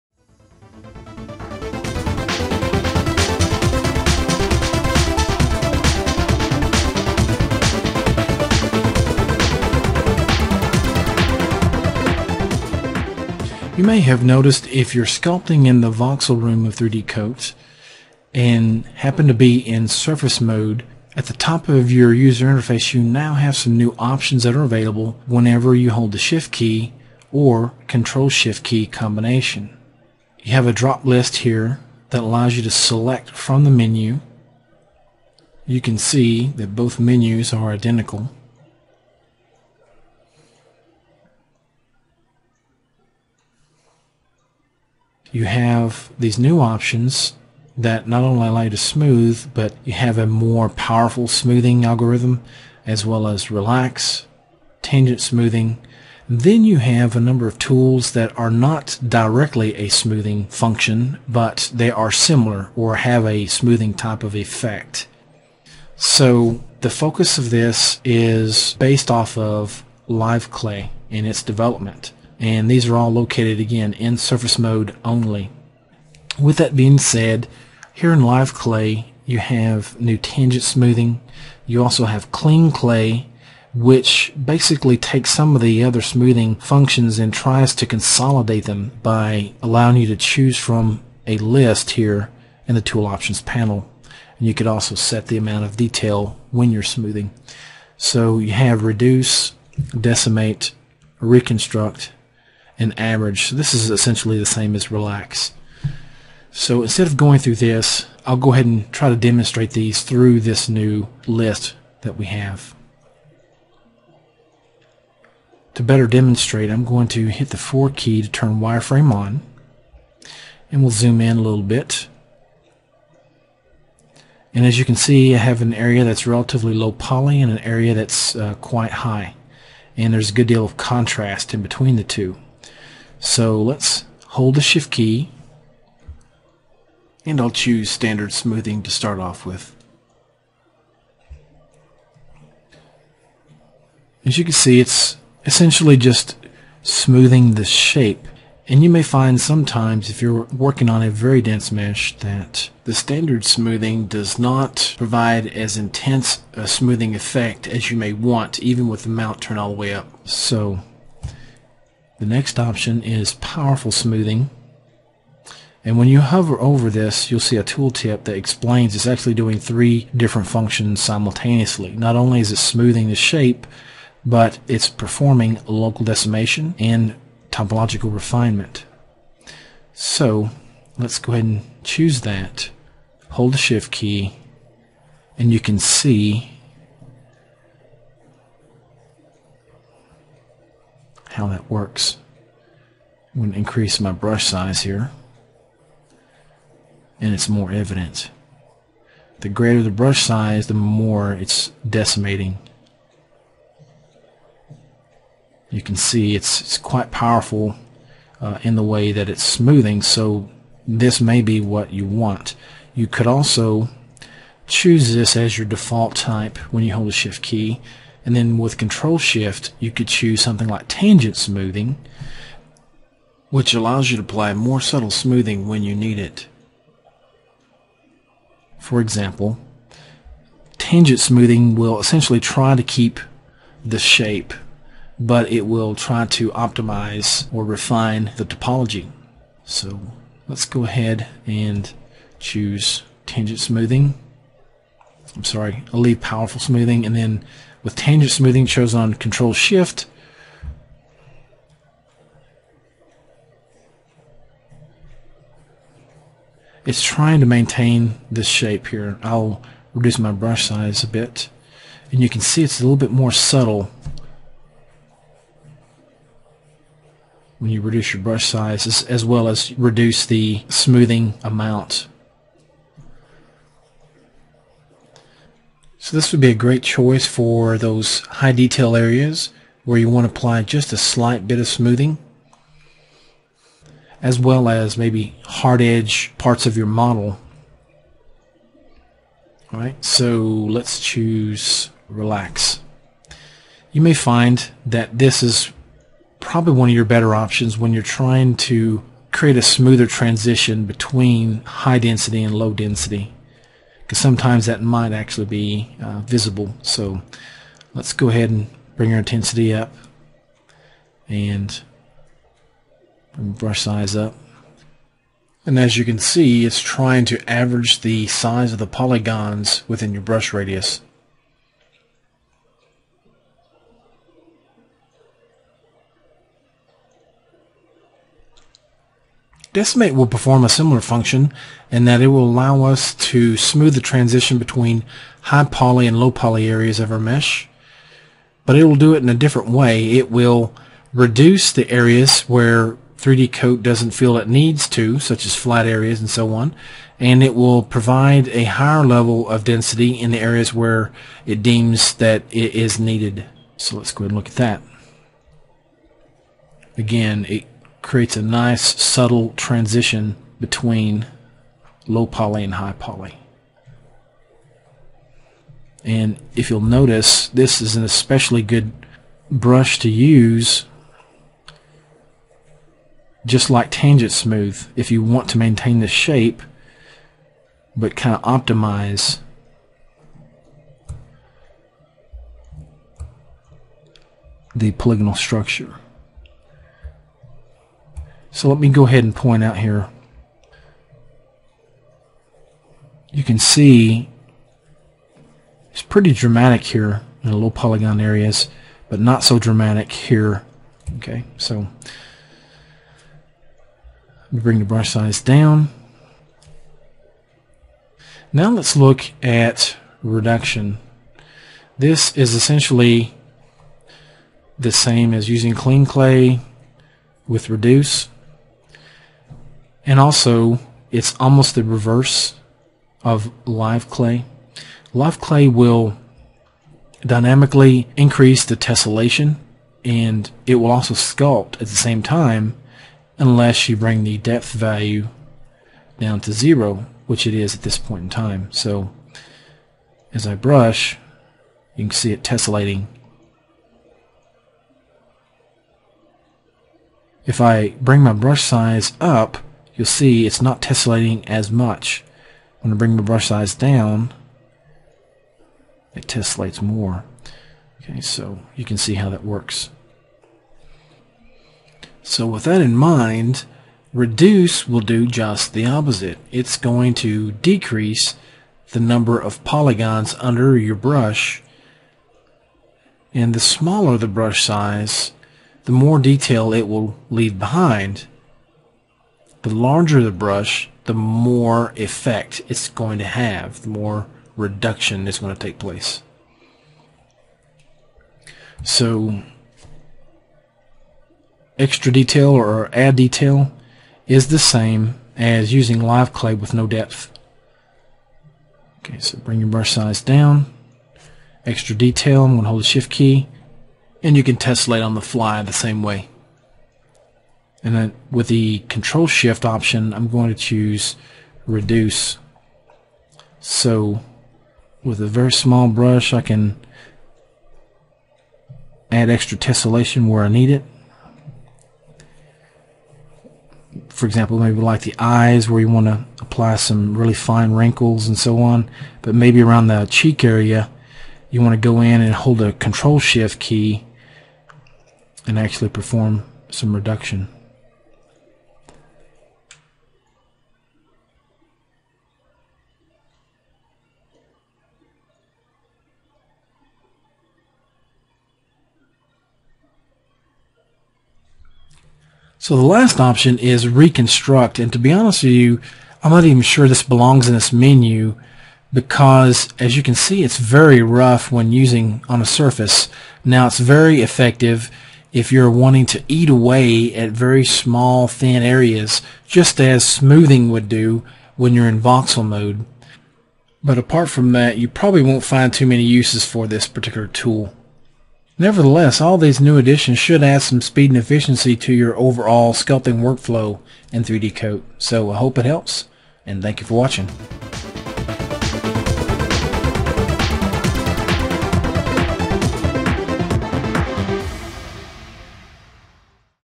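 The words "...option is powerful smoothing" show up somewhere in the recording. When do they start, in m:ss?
2:42.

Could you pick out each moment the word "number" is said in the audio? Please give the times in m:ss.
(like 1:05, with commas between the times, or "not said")
0:57, 7:48.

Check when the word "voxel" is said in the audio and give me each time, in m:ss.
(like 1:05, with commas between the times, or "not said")
0:15, 9:31.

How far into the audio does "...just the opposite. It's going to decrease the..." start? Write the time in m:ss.
7:45.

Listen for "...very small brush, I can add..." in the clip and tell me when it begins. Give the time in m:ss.
8:35.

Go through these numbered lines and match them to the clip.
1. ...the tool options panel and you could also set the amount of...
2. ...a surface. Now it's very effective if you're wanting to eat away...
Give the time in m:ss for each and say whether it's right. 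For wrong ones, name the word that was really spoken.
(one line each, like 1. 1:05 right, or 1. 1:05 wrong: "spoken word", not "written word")
1. 1:32 right
2. 9:22 right.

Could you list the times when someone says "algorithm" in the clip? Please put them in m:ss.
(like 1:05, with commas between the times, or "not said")
0:51.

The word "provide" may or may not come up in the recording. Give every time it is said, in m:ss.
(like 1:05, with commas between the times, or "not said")
2:34, 5:47.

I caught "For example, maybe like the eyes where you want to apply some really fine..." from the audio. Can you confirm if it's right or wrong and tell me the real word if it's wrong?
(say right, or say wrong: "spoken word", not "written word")
right.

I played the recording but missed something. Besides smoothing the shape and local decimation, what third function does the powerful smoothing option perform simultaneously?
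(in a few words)
Topological refinement.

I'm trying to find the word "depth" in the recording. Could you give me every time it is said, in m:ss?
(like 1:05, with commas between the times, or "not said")
7:14, 8:16.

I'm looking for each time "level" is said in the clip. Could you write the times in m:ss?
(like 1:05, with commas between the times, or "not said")
5:49.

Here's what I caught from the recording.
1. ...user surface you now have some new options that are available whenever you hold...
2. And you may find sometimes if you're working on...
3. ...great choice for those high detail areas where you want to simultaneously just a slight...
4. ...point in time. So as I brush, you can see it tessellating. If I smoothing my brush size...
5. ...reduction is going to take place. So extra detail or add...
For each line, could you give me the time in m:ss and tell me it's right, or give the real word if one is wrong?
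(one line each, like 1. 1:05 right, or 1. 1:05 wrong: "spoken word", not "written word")
1. 0:22 wrong: "interface", not "surface"
2. 2:28 right
3. 4:36 wrong: "apply", not "simultaneously"
4. 7:17 wrong: "bring", not "smoothing"
5. 8:04 right.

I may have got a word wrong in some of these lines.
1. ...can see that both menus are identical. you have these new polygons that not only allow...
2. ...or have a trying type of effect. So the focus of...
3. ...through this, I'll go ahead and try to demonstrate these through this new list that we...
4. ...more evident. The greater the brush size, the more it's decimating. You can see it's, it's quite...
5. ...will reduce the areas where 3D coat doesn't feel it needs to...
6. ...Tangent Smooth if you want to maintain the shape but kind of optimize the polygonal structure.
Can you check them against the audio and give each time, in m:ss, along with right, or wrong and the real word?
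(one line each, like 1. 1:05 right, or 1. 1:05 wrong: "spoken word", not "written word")
1. 0:35 wrong: "options", not "polygons"
2. 1:02 wrong: "smoothing", not "trying"
3. 1:47 right
4. 3:17 right
5. 5:40 right
6. 6:13 right.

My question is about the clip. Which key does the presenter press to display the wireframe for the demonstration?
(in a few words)
4.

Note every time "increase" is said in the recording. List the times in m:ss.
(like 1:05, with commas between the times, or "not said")
3:13, 7:08.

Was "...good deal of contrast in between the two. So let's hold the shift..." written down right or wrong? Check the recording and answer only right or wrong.
right.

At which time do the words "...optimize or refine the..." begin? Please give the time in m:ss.
3:56.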